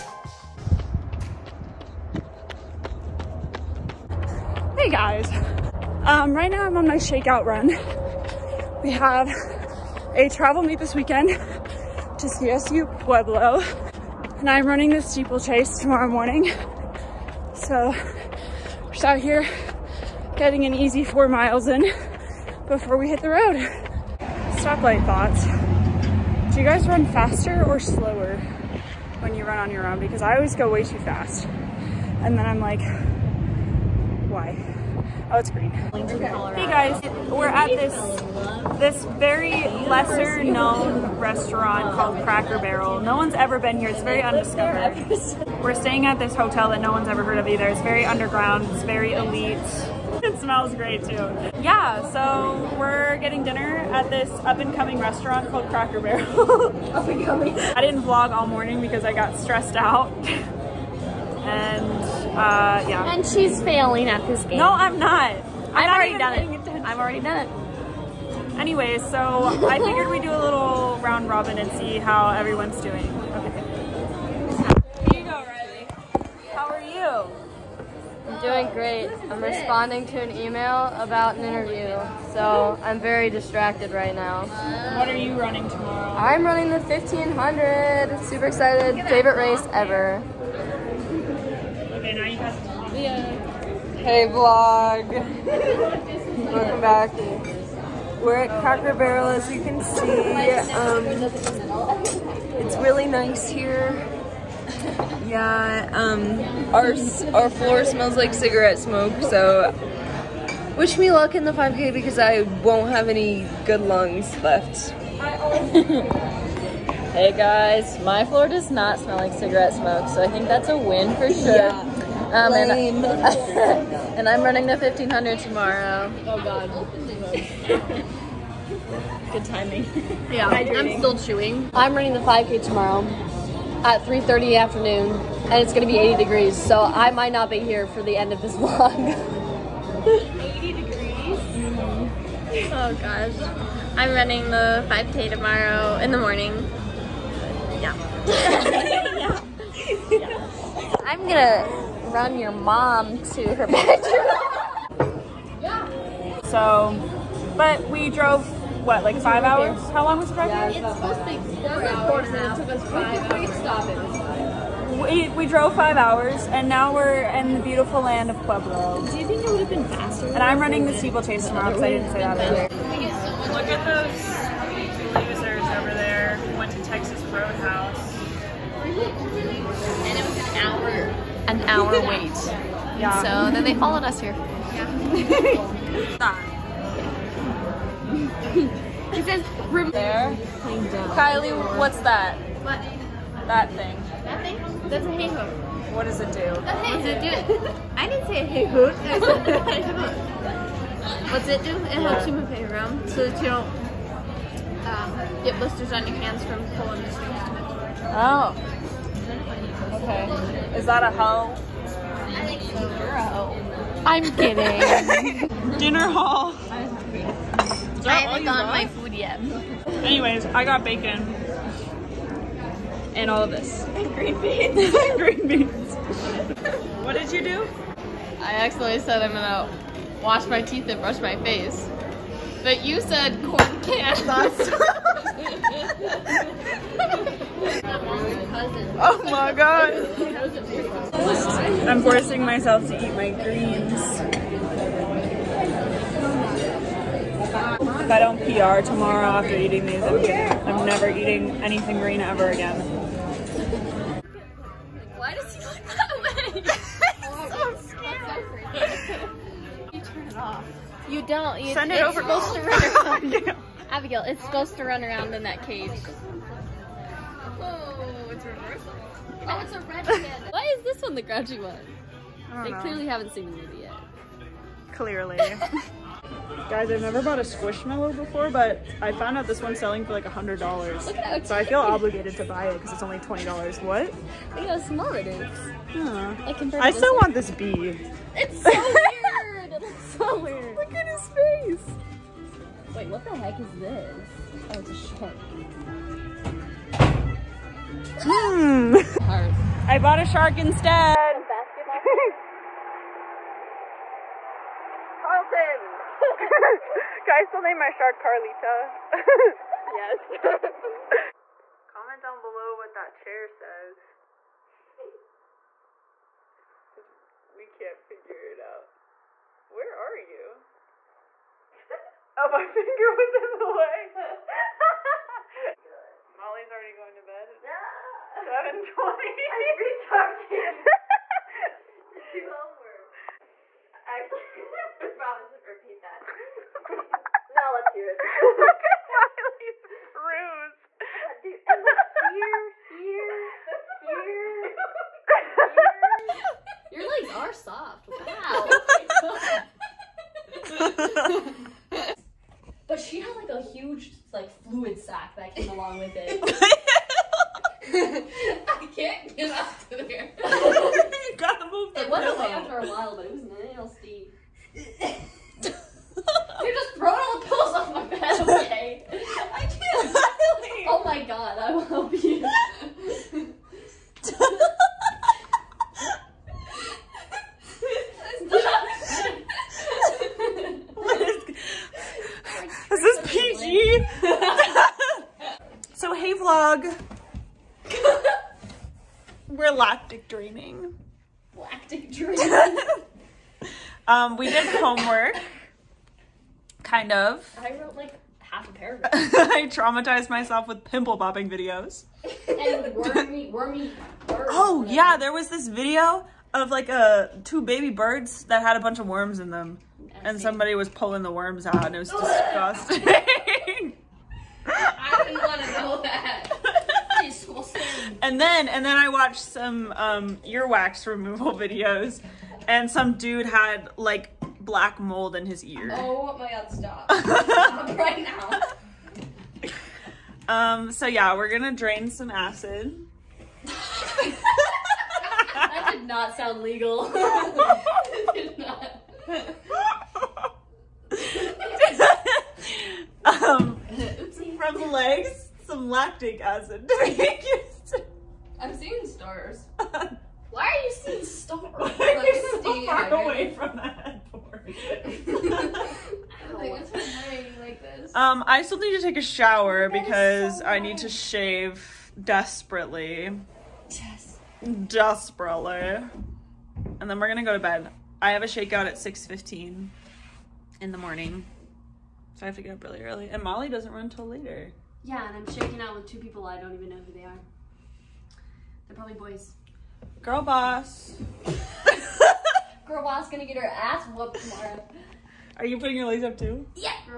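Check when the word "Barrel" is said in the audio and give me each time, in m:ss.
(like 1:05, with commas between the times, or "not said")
0:42, 0:55, 1:38.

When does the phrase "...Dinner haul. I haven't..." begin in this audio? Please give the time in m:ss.
3:35.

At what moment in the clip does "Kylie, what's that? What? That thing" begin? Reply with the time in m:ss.
3:11.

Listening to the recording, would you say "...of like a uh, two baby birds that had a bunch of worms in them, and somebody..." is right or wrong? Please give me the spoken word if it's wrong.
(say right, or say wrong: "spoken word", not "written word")
right.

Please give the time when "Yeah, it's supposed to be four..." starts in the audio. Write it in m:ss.
2:40.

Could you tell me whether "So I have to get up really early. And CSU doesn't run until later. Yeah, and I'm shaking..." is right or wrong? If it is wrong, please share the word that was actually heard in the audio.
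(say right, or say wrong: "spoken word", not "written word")
wrong: "Molly", not "CSU".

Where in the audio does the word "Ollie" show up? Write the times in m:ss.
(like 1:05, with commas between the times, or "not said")
5:26, 5:39.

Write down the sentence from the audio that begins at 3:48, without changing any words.
I accidentally said I'm gonna wash my teeth and brush my face.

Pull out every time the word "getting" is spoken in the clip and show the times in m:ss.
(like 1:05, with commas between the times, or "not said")
0:20, 0:53.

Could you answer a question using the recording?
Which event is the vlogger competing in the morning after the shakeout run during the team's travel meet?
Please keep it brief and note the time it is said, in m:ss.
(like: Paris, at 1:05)
Steeplechase, at 0:14.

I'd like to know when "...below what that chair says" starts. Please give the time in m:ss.
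5:12.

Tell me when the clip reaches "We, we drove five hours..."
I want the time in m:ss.
2:44.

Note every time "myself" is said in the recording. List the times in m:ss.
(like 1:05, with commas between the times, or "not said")
4:02, 6:40.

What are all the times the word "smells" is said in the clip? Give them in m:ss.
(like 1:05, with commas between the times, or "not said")
0:50, 1:47, 1:58.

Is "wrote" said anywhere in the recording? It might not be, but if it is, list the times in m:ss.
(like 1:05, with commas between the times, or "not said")
6:37.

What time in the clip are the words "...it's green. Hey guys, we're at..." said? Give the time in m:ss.
0:35.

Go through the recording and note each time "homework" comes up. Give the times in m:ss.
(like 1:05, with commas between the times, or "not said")
5:32, 6:34.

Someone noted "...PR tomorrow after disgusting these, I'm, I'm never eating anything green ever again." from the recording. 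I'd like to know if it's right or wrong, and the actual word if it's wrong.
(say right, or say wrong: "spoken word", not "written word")
wrong: "eating", not "disgusting".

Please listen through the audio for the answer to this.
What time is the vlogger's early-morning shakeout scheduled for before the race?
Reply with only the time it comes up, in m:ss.
7:48.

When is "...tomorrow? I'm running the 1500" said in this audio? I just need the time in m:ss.
1:25.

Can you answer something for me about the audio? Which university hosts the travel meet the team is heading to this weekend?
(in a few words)
CSU Pueblo.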